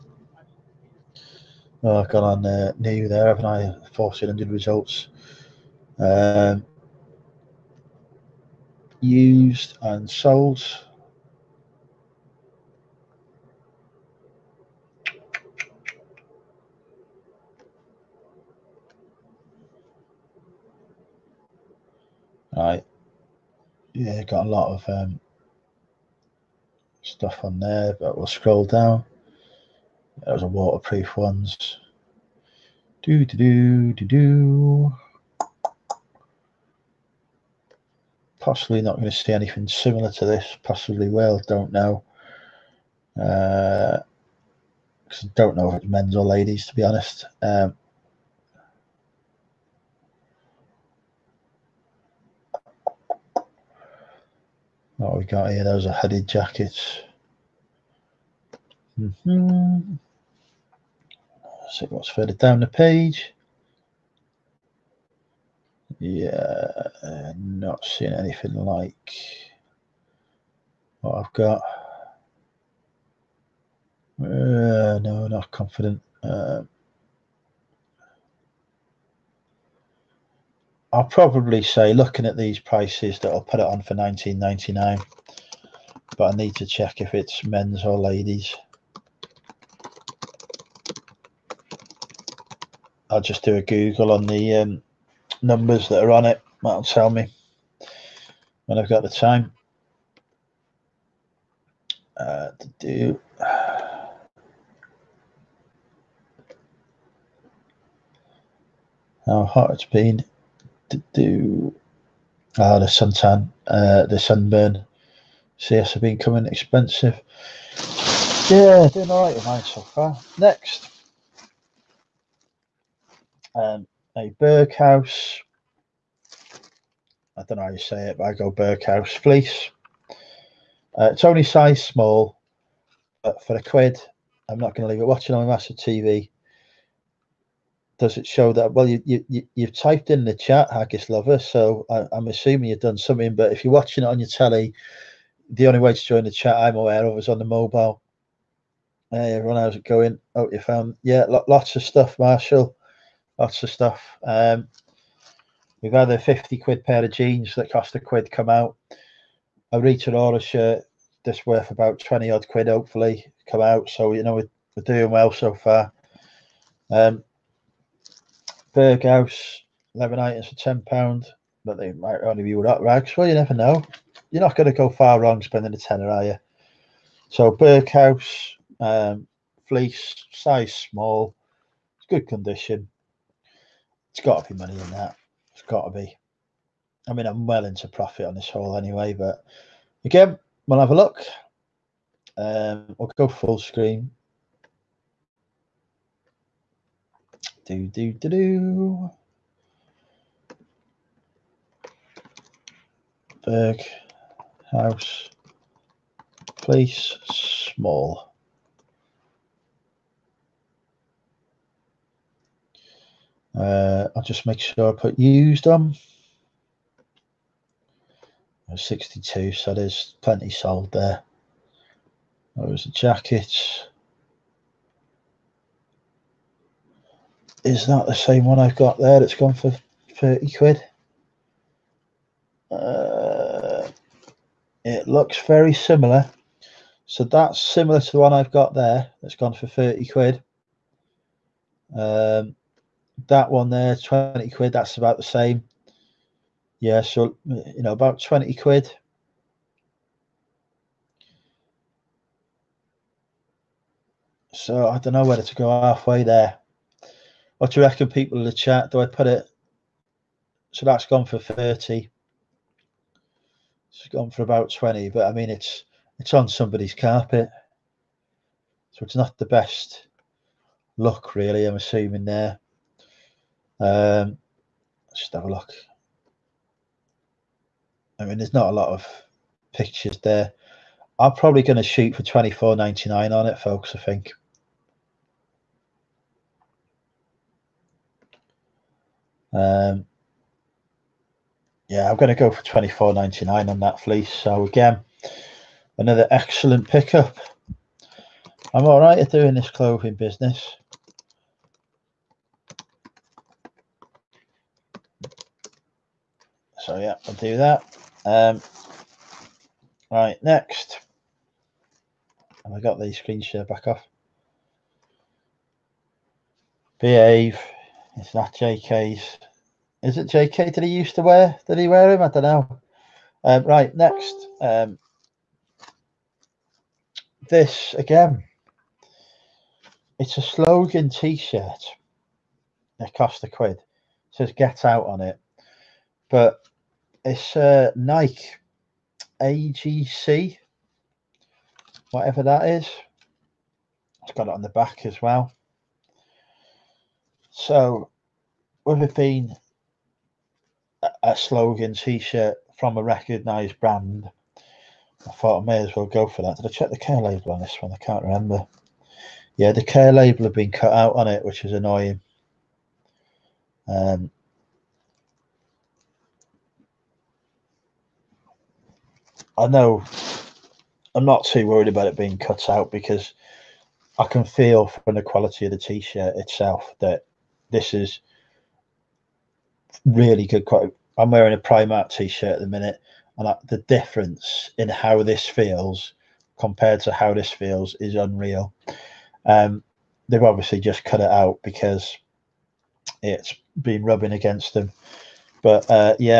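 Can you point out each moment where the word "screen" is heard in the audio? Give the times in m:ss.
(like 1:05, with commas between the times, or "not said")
3:13, 5:13.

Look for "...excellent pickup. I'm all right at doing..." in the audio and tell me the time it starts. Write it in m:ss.
4:56.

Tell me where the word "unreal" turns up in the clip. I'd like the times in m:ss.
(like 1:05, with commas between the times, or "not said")
6:28.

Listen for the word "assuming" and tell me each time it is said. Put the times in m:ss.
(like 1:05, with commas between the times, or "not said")
2:22, 4:31.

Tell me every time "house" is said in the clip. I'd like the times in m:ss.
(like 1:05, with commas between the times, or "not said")
2:48, 3:24.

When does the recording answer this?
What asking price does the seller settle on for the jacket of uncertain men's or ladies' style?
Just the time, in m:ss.
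1:23.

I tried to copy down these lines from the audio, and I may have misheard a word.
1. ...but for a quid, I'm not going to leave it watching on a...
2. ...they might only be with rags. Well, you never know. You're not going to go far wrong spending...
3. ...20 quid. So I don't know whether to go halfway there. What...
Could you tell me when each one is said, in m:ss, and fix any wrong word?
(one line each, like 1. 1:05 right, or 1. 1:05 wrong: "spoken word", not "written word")
1. 2:13 right
2. 2:51 right
3. 4:08 right.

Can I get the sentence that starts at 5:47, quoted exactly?
So, with it being a slogan t-shirt from a recognised brand, I thought I may as well go for that.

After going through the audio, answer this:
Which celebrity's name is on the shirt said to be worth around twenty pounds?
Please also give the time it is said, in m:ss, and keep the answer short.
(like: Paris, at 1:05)
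Rita Ora, at 2:39.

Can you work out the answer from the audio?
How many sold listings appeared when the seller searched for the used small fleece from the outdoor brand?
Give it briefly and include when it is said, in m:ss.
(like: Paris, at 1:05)
62, at 3:38.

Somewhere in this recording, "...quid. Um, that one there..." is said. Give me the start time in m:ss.
4:00.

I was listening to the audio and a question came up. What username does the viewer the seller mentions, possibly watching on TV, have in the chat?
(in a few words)
Haggis Lover.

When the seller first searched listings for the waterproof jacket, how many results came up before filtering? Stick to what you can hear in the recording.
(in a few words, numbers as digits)
1400.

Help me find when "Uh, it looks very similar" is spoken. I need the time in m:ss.
3:52.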